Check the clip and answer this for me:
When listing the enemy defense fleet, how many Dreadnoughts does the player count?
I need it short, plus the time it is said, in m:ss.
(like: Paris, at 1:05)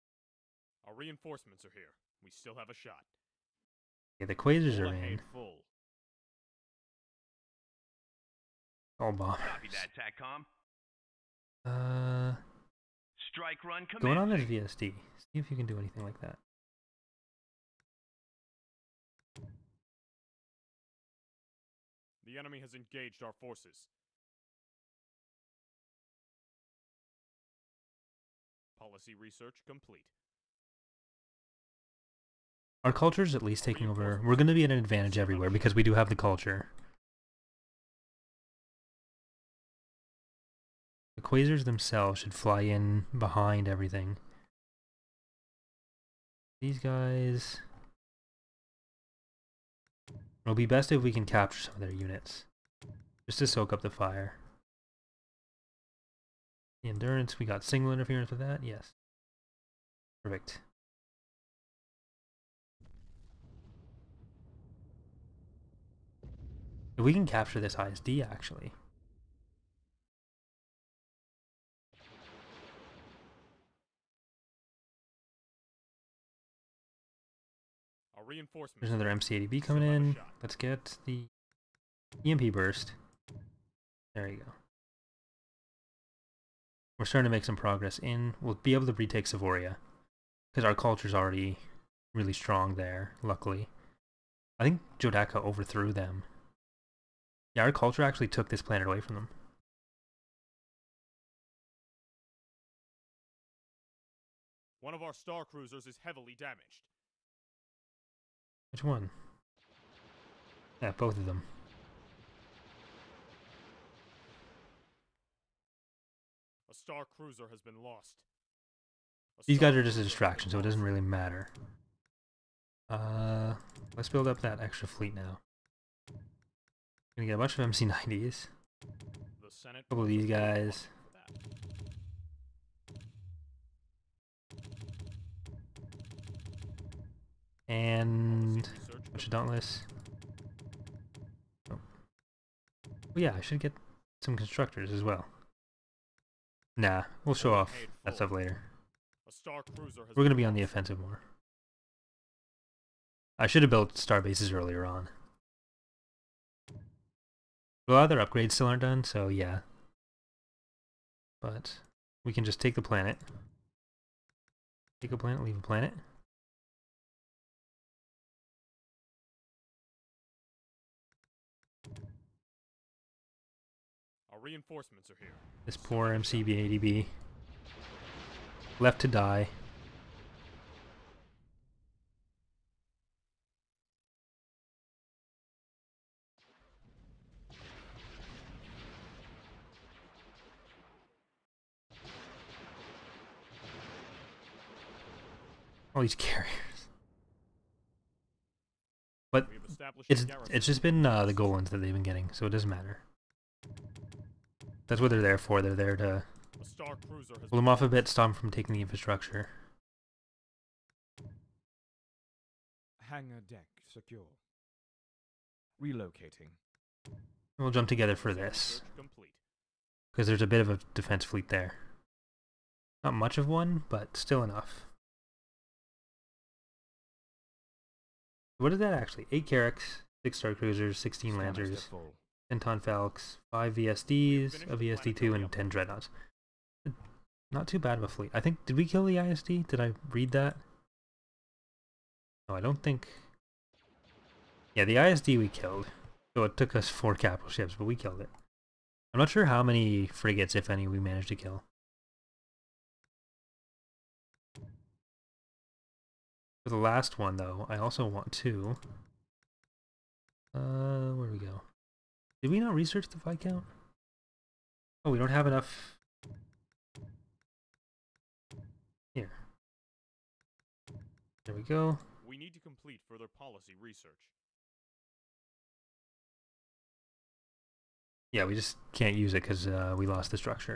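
10, at 3:55.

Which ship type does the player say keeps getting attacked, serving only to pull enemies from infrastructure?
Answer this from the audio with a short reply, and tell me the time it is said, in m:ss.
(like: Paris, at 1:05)
Golans, at 3:21.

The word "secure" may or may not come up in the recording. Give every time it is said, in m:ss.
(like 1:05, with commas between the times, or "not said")
3:33.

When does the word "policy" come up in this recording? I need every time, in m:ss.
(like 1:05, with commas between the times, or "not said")
0:28, 4:33.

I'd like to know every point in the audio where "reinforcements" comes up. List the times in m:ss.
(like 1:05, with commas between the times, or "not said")
0:00, 2:54.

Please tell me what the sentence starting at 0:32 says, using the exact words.
Our culture is at least taking over.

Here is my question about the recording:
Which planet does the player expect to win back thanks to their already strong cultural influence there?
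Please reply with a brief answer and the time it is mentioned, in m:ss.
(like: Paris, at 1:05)
Savoria, at 1:29.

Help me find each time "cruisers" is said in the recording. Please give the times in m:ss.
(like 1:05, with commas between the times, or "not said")
1:45, 1:57, 3:50.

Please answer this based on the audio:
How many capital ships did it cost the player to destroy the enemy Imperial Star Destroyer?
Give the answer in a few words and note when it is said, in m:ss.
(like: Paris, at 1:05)
4, at 4:06.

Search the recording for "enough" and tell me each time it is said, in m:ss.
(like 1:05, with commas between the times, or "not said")
3:44, 4:25.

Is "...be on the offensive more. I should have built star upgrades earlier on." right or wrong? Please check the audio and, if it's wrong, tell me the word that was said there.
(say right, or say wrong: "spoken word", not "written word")
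wrong: "bases", not "upgrades".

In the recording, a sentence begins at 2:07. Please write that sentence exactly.
Gonna get a bunch of MC90s.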